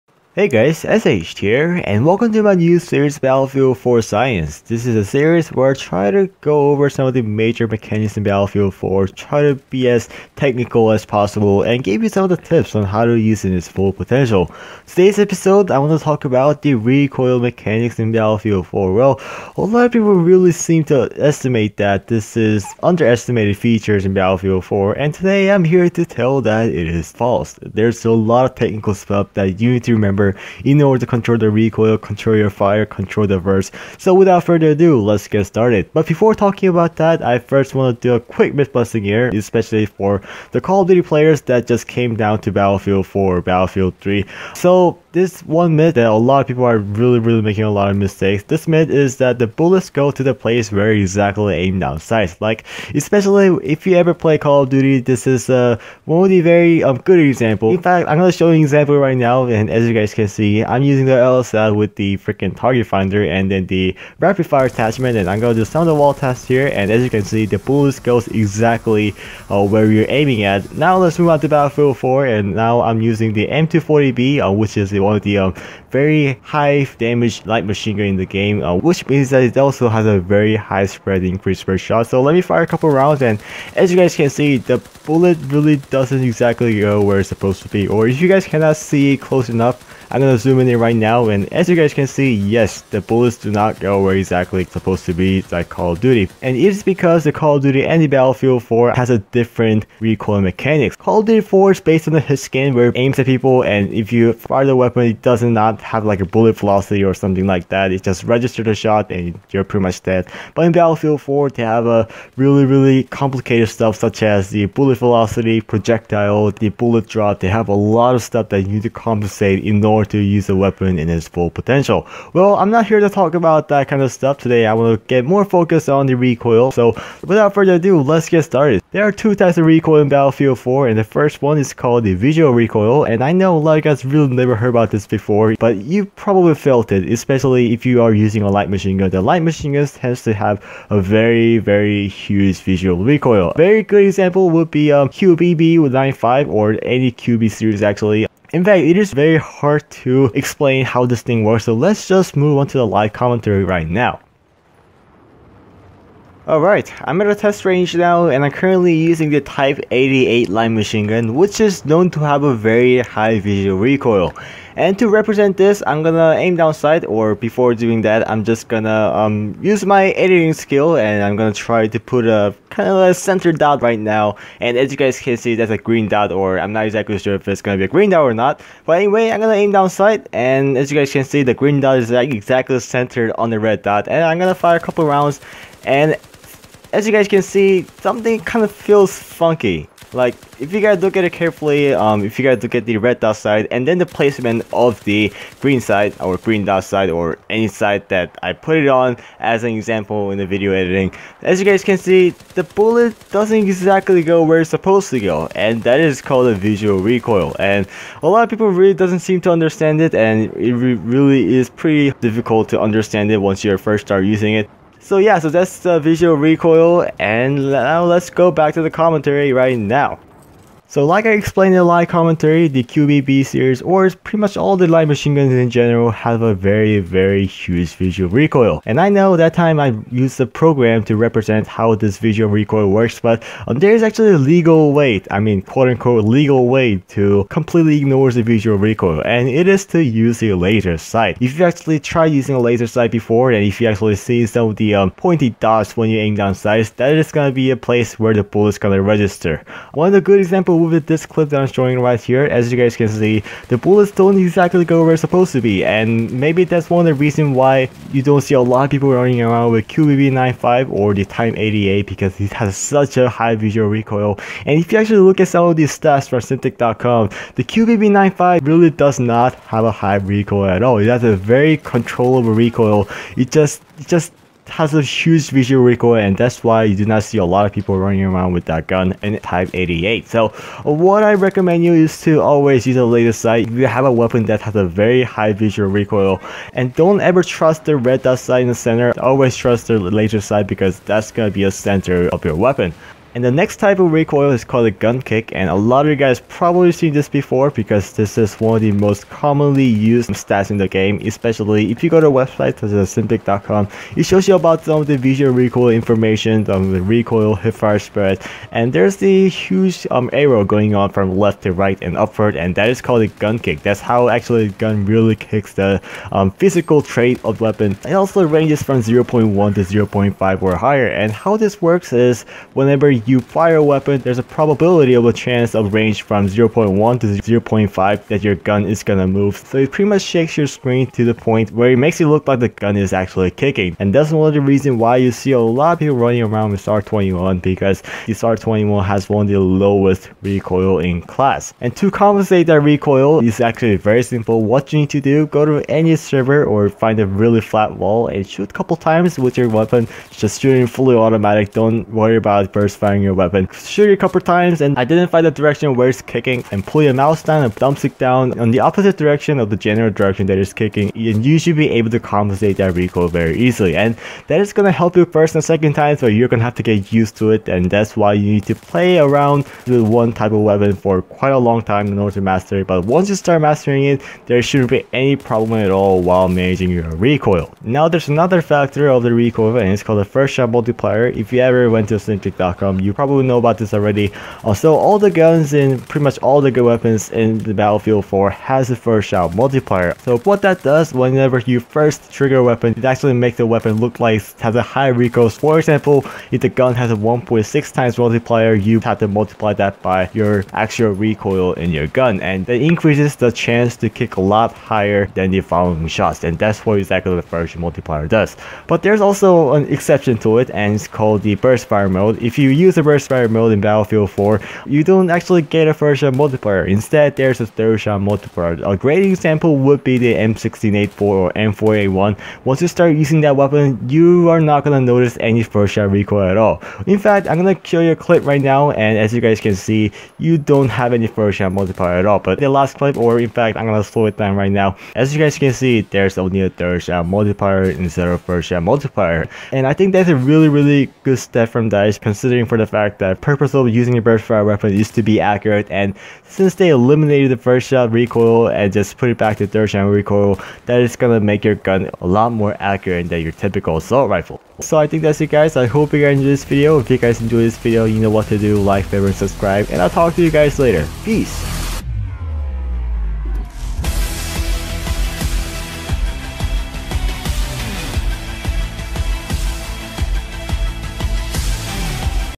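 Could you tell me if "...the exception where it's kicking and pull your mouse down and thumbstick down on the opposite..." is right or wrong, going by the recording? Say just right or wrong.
wrong.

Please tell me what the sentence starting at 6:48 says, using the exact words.
But there's also an exception to it and it's called the burst fire mode.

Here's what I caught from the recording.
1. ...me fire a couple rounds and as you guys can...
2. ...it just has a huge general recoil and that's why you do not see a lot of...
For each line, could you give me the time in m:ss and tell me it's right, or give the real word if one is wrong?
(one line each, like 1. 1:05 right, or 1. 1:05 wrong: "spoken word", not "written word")
1. 1:22 right
2. 4:33 wrong: "visual", not "general".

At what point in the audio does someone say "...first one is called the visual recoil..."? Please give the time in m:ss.
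2:11.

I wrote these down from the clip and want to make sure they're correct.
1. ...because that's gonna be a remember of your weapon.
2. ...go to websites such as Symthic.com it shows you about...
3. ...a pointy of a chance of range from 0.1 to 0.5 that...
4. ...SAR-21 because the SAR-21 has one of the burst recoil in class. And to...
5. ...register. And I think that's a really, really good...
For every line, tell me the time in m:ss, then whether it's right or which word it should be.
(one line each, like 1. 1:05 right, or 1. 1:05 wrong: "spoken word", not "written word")
1. 4:50 wrong: "center", not "remember"
2. 5:02 right
3. 5:24 wrong: "probability", not "pointy"
4. 5:36 wrong: "lowest", not "burst"
5. 7:18 wrong: "multiplier", not "register".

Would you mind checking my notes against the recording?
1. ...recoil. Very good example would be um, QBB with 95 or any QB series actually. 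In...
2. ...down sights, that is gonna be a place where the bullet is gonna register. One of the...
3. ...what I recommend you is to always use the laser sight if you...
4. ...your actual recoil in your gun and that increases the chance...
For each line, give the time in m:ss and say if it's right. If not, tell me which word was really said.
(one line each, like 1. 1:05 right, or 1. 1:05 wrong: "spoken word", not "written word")
1. 2:23 right
2. 4:06 right
3. 4:40 right
4. 6:40 right.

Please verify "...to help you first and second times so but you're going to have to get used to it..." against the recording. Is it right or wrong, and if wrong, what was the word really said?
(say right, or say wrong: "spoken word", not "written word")
right.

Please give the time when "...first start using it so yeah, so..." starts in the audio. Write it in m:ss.
3:33.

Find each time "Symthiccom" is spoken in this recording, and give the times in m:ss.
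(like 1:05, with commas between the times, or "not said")
4:26, 5:03, 6:22.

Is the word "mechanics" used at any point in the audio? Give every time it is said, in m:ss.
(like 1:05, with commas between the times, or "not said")
0:07, 0:17, 1:40.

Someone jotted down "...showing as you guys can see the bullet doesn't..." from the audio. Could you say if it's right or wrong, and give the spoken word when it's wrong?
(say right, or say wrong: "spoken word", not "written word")
wrong: "editing", not "showing".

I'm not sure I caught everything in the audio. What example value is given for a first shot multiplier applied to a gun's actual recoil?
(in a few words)
1.6.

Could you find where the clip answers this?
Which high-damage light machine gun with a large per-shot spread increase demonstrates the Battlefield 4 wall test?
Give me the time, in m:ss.
1:13.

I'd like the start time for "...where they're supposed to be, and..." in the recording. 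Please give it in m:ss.
4:15.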